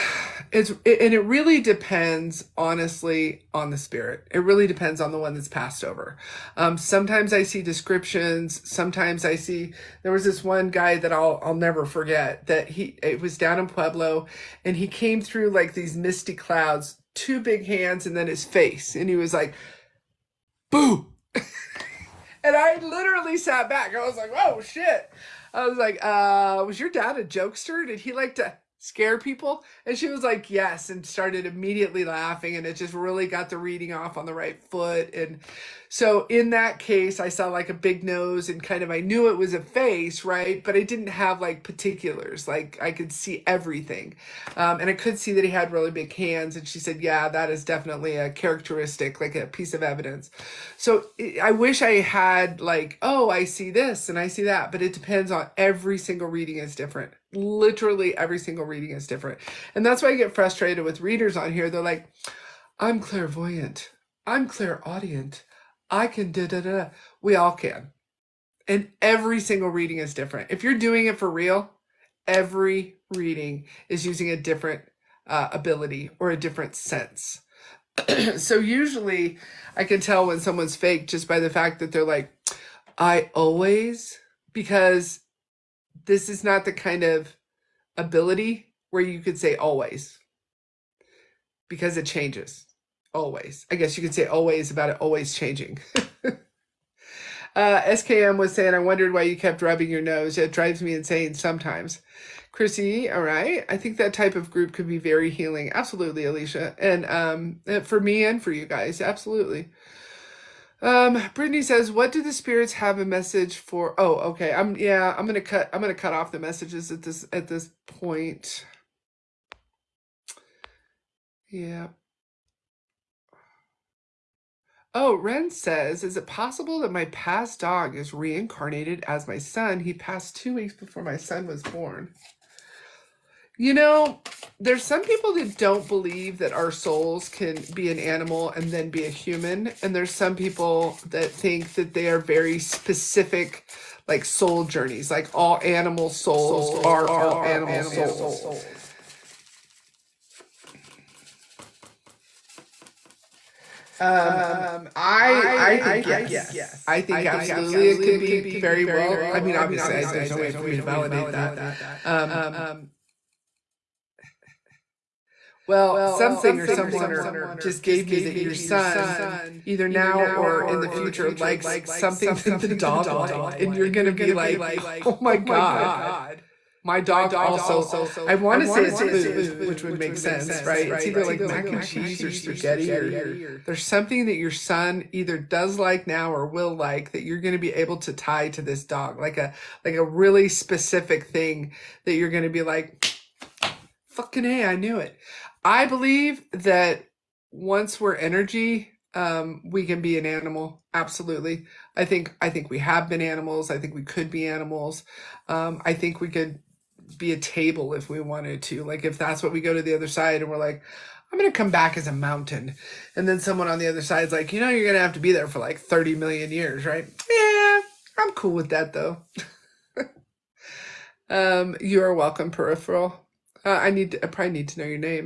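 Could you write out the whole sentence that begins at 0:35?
And so in that case, I saw like a big nose and kind of, I knew it was a face, right?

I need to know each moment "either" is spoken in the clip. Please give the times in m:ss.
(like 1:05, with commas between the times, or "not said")
2:49, 3:01, 3:05.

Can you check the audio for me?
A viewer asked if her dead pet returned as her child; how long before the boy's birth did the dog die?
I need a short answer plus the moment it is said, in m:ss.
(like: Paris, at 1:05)
2 weeks, at 2:10.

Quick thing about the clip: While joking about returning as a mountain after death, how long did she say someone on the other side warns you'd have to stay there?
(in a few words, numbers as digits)
30 million years.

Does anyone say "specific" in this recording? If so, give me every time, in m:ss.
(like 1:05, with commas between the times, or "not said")
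2:22, 3:10.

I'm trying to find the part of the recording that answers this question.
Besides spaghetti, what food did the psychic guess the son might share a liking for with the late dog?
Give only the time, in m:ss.
3:01.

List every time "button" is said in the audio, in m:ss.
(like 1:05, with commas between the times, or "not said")
not said.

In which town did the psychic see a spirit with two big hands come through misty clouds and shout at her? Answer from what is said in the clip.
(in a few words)
Pueblo.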